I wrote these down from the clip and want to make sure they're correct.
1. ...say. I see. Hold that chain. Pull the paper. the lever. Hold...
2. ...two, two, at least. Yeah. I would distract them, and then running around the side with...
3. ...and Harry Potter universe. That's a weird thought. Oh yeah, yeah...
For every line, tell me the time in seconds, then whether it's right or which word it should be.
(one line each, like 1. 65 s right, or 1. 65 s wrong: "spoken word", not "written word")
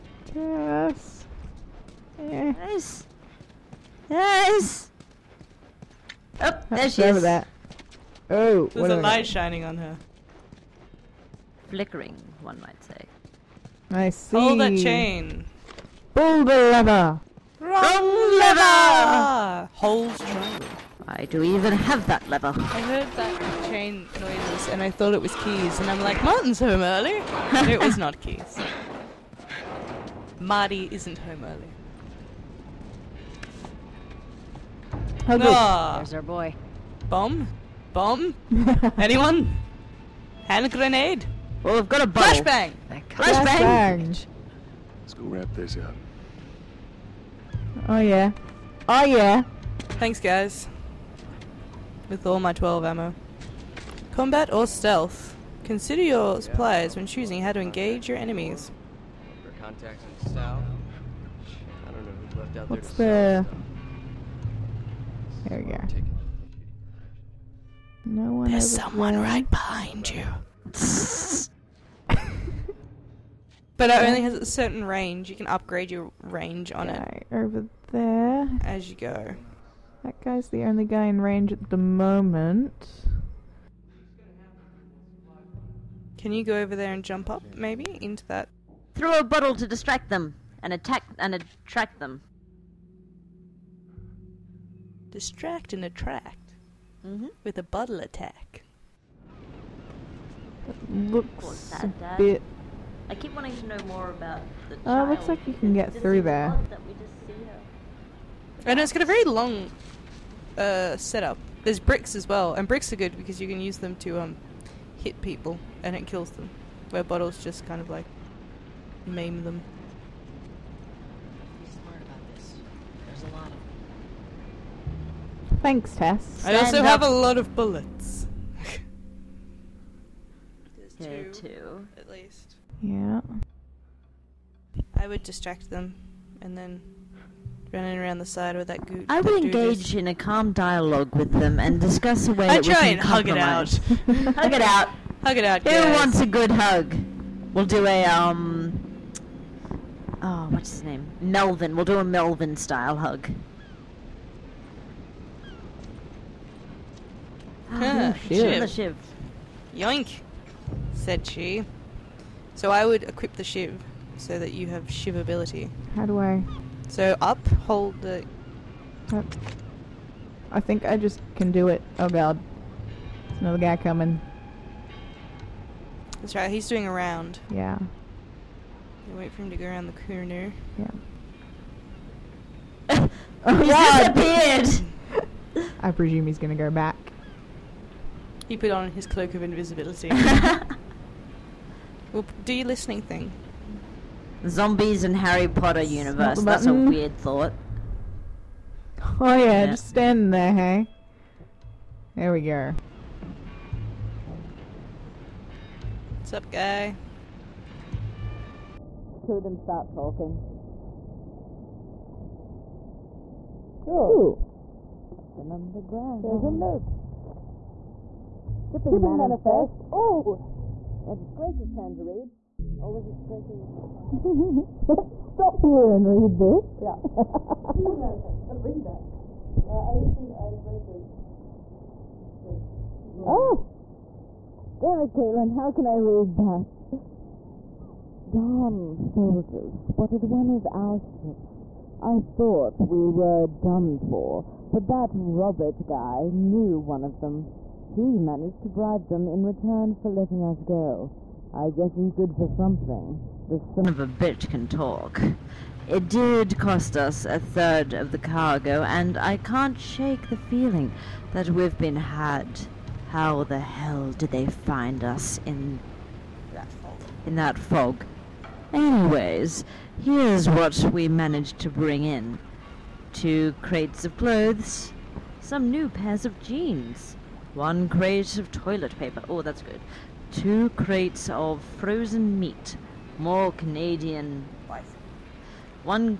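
1. 12 s wrong: "lever", not "paper"
2. 131 s right
3. 195 s right.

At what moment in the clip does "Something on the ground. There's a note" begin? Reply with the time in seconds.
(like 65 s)
215 s.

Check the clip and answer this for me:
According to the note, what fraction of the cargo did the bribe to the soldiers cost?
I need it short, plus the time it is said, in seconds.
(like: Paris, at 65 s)
A third, at 257 s.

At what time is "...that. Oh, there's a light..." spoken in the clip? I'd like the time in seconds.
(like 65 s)
7 s.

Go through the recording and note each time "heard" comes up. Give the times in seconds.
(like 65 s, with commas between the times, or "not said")
22 s.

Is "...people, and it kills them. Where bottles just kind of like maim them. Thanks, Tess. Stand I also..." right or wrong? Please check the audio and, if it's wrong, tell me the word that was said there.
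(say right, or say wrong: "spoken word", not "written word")
right.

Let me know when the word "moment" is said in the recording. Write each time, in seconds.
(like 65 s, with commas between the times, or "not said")
81 s.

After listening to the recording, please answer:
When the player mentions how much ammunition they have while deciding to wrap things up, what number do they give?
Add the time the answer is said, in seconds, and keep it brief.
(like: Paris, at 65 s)
12, at 52 s.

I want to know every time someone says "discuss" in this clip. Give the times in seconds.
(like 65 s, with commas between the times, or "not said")
141 s.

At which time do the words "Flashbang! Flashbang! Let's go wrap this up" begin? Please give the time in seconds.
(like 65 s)
42 s.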